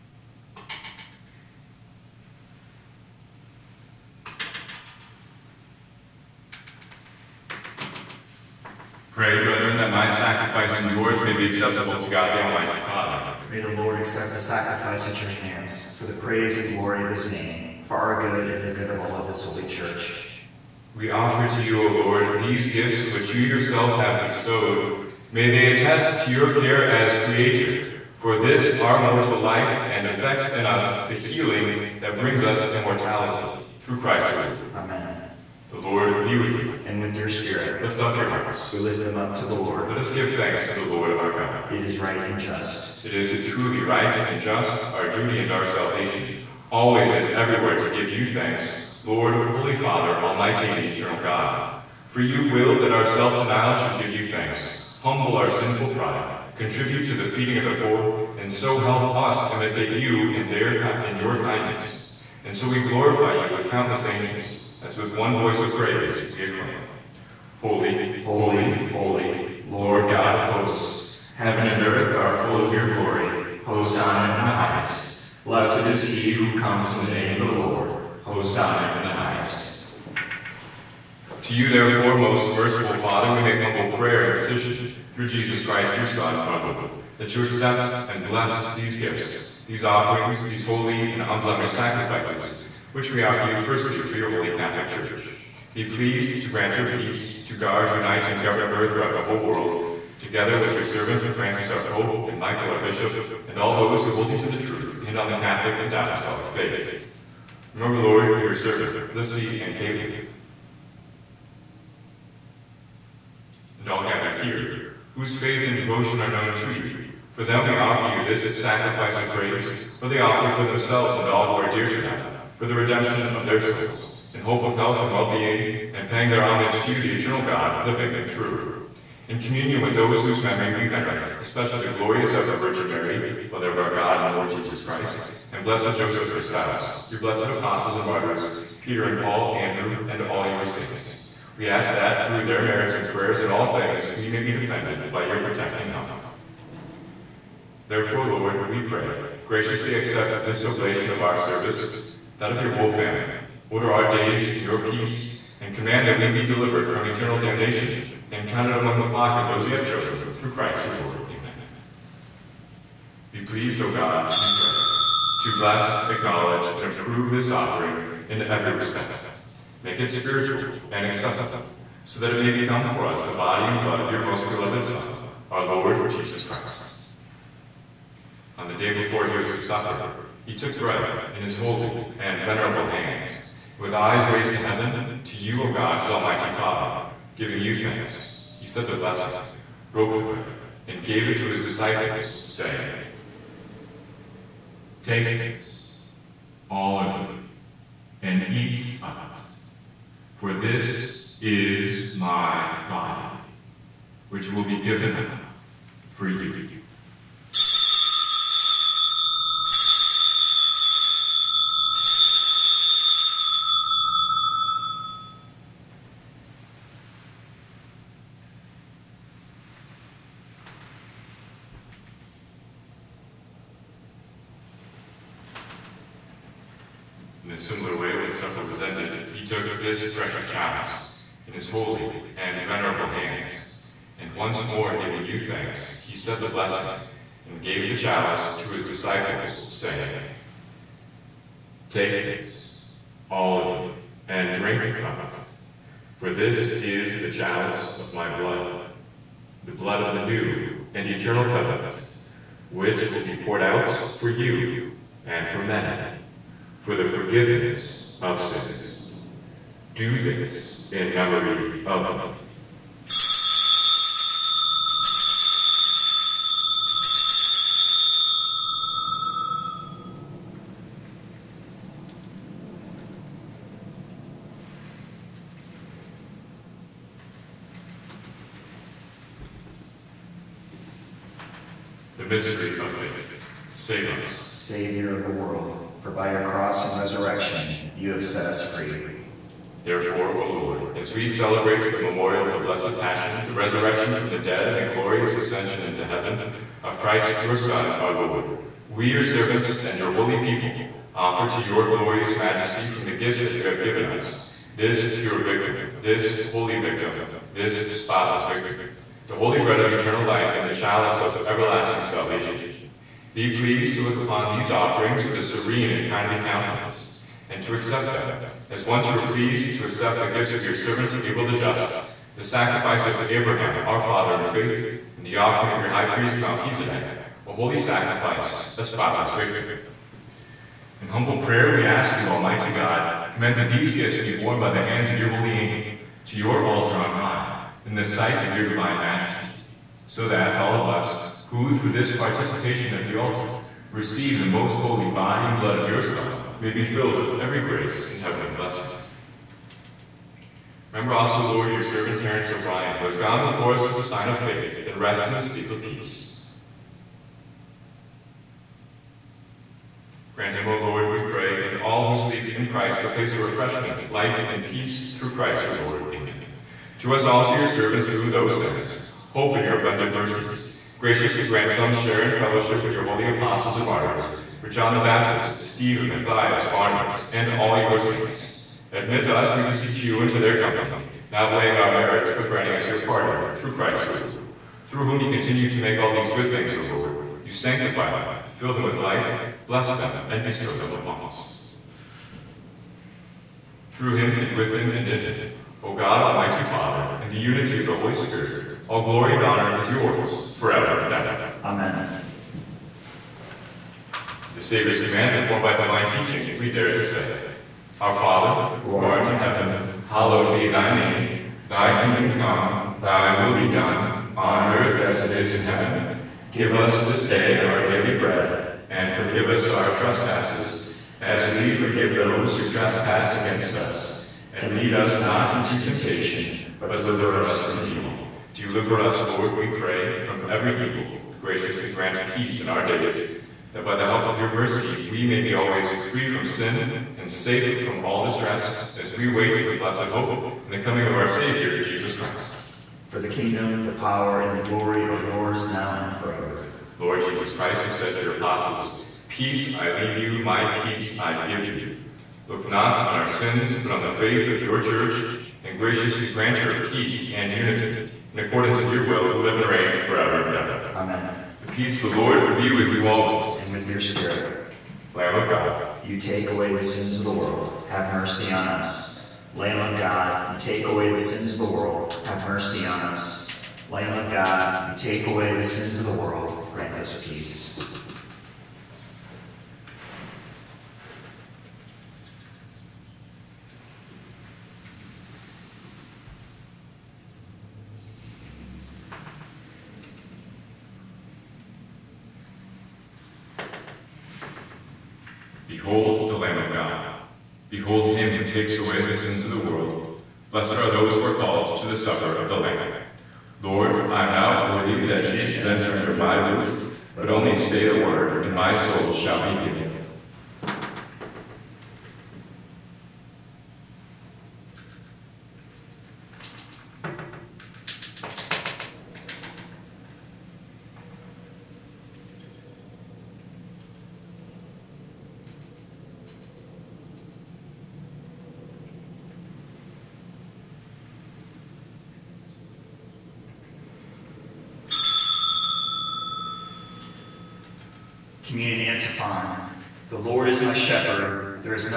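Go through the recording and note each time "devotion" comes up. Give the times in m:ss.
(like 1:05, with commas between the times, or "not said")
1:55.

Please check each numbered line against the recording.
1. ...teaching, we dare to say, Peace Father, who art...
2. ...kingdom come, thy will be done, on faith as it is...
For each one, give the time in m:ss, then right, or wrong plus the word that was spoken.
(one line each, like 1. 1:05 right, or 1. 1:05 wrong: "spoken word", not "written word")
1. 6:46 wrong: "Our", not "Peace"
2. 6:51 wrong: "earth", not "faith".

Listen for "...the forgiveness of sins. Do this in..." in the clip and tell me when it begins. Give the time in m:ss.
4:16.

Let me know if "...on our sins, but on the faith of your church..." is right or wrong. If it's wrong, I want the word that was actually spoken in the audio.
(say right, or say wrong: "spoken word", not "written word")
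right.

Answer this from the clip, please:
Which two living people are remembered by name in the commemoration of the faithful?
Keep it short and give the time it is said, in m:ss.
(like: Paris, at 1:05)
Lissy and Caitlin, at 1:49.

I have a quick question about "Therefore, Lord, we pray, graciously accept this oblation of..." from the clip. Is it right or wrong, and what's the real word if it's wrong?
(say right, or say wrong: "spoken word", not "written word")
right.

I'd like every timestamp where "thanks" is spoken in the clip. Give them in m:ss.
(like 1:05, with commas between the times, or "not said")
0:40, 0:48, 0:54, 3:07, 3:55.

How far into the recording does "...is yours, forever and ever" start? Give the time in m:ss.
6:39.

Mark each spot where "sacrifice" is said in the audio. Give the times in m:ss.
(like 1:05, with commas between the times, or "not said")
0:10, 0:14, 1:31, 1:58, 5:22, 5:27.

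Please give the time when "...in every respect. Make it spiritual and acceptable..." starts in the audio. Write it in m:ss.
2:48.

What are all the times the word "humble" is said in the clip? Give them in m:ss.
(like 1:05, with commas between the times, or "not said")
0:54, 1:23, 5:31.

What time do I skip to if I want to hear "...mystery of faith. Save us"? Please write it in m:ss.
4:42.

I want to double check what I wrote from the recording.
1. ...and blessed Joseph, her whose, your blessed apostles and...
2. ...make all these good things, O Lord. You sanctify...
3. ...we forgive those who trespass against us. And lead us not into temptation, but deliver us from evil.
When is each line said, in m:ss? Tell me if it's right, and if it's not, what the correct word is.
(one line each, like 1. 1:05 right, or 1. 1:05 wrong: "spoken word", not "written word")
1. 2:15 wrong: "spouse", not "whose"
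2. 6:25 right
3. 7:01 right.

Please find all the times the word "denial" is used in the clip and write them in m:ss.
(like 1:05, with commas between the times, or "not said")
0:53.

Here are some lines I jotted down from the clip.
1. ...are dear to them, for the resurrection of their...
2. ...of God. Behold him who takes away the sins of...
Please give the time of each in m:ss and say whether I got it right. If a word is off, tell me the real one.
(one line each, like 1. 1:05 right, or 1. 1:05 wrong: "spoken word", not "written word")
1. 2:01 wrong: "redemption", not "resurrection"
2. 8:16 right.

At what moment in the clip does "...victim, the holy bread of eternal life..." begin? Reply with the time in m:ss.
5:08.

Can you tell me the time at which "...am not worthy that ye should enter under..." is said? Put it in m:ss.
8:24.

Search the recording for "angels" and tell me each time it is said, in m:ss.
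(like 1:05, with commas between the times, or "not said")
1:04, 5:35.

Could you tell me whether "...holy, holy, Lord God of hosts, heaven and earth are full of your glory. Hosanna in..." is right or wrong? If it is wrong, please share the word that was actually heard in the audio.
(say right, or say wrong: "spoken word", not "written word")
right.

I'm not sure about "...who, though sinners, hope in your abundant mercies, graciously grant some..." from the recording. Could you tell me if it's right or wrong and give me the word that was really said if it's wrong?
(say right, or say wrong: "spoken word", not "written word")
right.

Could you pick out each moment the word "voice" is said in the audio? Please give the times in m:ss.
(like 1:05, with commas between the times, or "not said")
1:05.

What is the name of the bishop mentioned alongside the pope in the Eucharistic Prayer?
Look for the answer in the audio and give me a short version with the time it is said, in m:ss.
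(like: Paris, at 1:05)
Michael, at 1:42.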